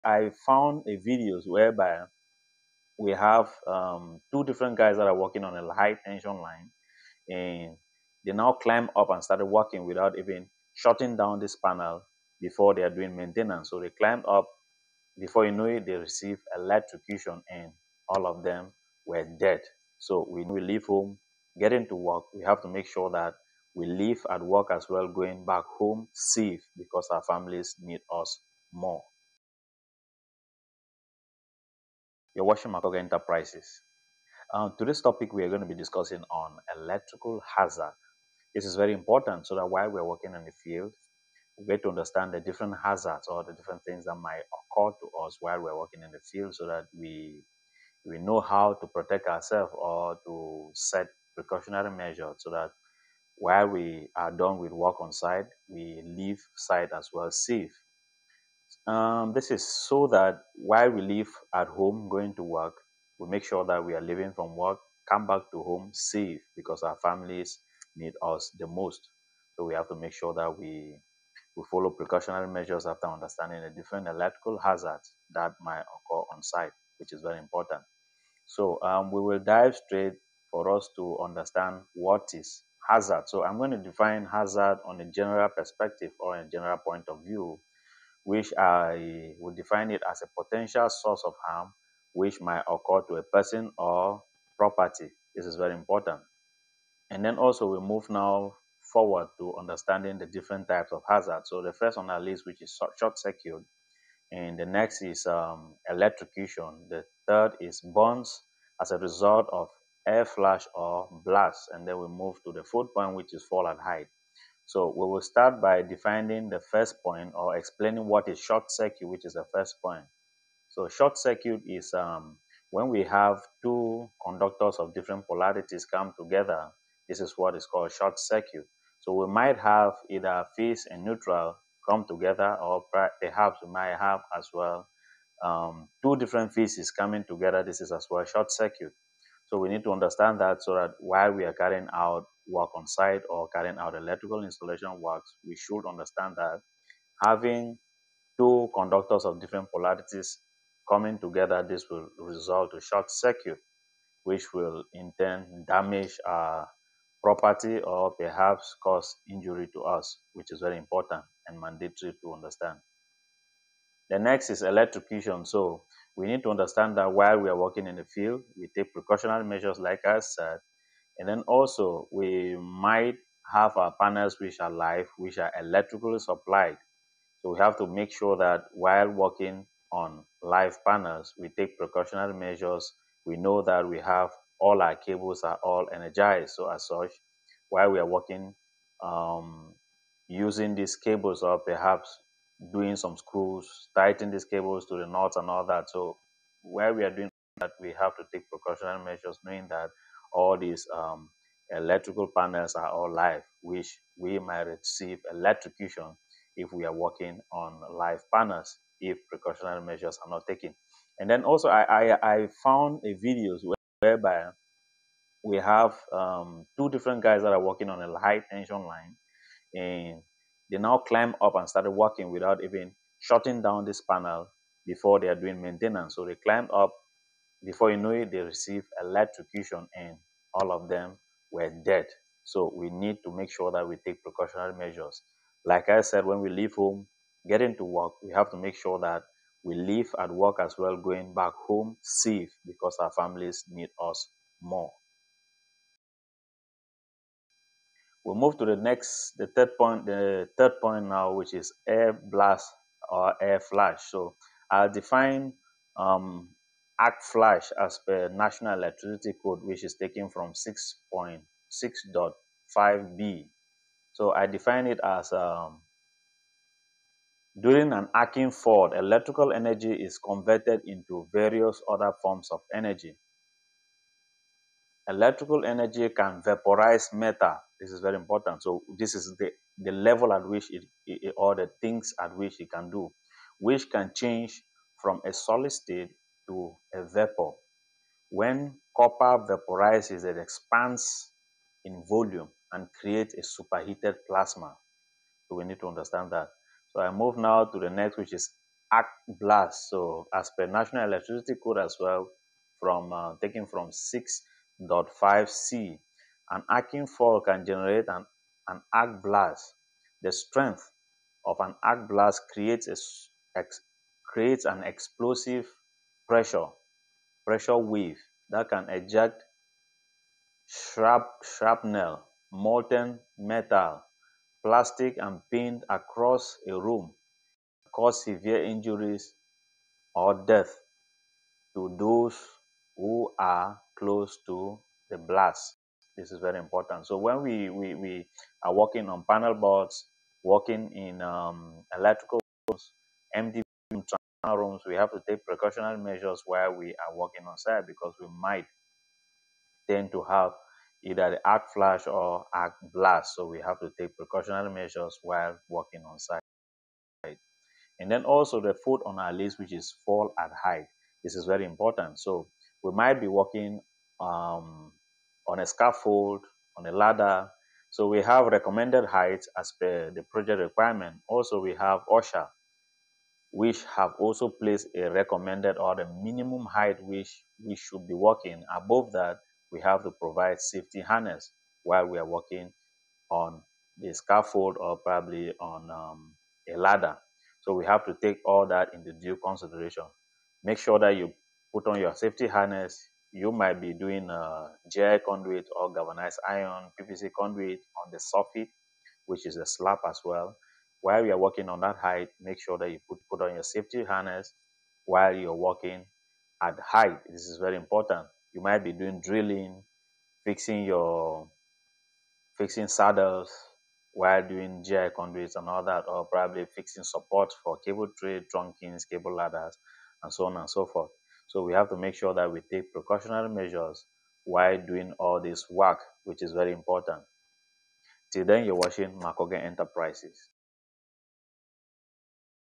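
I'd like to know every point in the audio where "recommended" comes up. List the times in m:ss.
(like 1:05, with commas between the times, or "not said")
6:08, 6:15.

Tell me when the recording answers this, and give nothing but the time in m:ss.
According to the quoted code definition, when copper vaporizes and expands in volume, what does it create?
4:53.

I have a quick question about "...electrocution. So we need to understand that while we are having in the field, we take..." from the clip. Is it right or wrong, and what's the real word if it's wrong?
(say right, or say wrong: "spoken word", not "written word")
wrong: "working", not "having".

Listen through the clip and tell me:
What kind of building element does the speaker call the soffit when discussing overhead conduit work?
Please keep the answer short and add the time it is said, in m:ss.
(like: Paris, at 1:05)
A slab, at 6:39.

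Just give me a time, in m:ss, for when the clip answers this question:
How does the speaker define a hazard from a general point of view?
1:30.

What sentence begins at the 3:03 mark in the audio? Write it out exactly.
We know that we have all our cables are all energized.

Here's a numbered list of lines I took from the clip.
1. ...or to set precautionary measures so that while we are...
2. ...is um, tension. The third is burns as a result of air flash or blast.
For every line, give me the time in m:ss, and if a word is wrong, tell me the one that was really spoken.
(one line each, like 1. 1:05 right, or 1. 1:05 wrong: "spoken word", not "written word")
1. 0:49 right
2. 1:45 wrong: "electrocution", not "tension".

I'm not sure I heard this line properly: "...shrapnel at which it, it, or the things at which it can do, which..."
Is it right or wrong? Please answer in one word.
wrong.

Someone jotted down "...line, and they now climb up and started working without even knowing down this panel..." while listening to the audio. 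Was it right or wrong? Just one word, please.
wrong.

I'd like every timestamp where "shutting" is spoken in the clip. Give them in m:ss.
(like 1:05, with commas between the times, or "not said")
0:10, 3:43.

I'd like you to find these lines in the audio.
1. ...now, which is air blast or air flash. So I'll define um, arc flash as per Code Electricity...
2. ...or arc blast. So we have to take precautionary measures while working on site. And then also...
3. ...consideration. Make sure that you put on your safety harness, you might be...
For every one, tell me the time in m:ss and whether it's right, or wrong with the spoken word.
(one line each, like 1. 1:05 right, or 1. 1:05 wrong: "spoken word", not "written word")
1. 4:11 wrong: "National", not "Code"
2. 5:52 right
3. 6:29 right.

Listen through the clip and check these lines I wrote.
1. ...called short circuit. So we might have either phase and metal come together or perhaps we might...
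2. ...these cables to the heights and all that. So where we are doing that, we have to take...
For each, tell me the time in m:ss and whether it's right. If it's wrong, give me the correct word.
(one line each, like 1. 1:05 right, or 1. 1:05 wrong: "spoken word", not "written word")
1. 2:07 wrong: "neutral", not "metal"
2. 3:14 wrong: "knots", not "heights".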